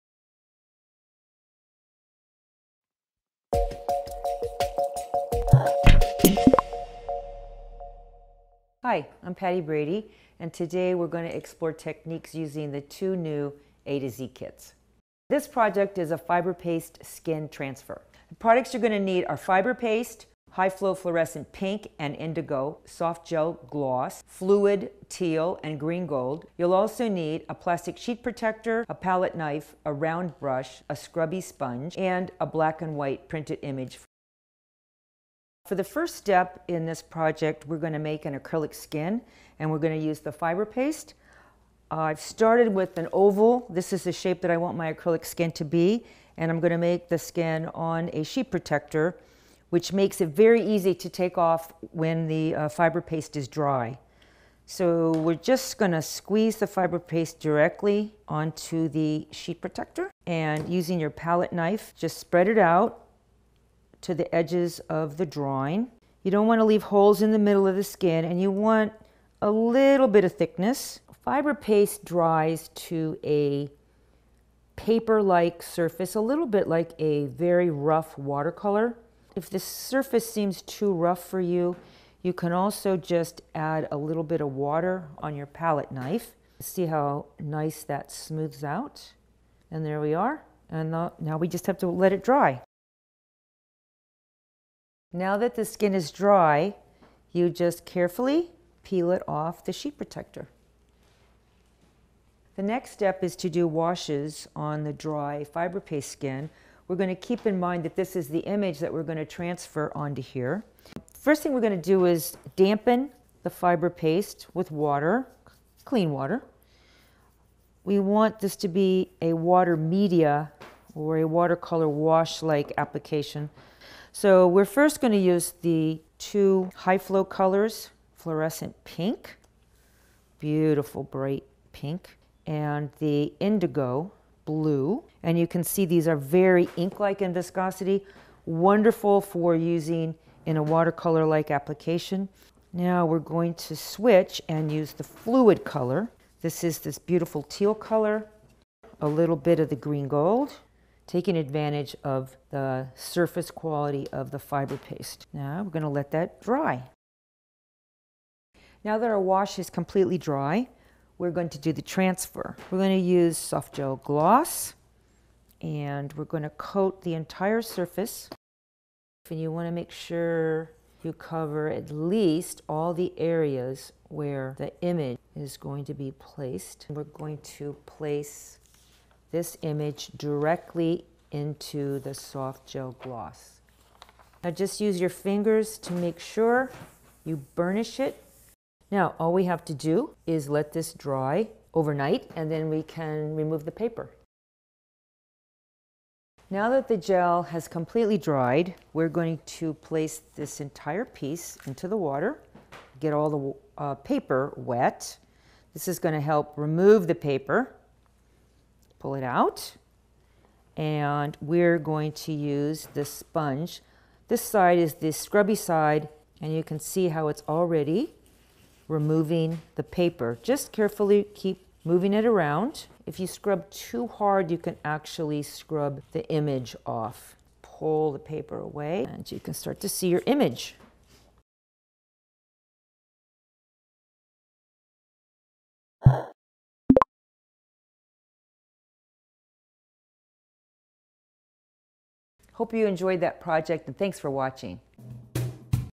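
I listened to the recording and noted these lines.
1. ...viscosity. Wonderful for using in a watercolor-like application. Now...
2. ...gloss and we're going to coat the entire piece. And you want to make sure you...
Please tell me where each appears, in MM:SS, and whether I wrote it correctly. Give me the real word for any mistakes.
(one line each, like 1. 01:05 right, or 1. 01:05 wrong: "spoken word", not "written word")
1. 02:17 right
2. 02:43 wrong: "surface", not "piece".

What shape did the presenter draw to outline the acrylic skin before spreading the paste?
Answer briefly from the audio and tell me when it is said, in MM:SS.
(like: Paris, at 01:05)
Oval, at 00:43.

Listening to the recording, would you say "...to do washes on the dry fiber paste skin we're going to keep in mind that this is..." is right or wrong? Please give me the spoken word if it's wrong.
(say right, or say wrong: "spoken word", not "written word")
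right.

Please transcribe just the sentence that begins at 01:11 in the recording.
Fiber paste dries to a paper-like surface, a little bit like a very rough watercolor.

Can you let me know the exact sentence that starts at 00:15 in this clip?
This project is a fiber paste skin transfer.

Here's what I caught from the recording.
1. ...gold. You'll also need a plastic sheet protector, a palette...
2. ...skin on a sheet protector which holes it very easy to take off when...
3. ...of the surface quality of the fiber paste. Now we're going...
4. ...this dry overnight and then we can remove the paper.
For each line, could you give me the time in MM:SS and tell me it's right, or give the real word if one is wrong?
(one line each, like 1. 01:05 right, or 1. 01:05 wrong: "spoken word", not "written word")
1. 00:26 right
2. 00:47 wrong: "makes", not "holes"
3. 02:32 right
4. 03:10 right.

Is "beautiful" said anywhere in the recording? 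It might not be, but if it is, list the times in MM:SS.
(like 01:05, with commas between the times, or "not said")
02:10, 02:26.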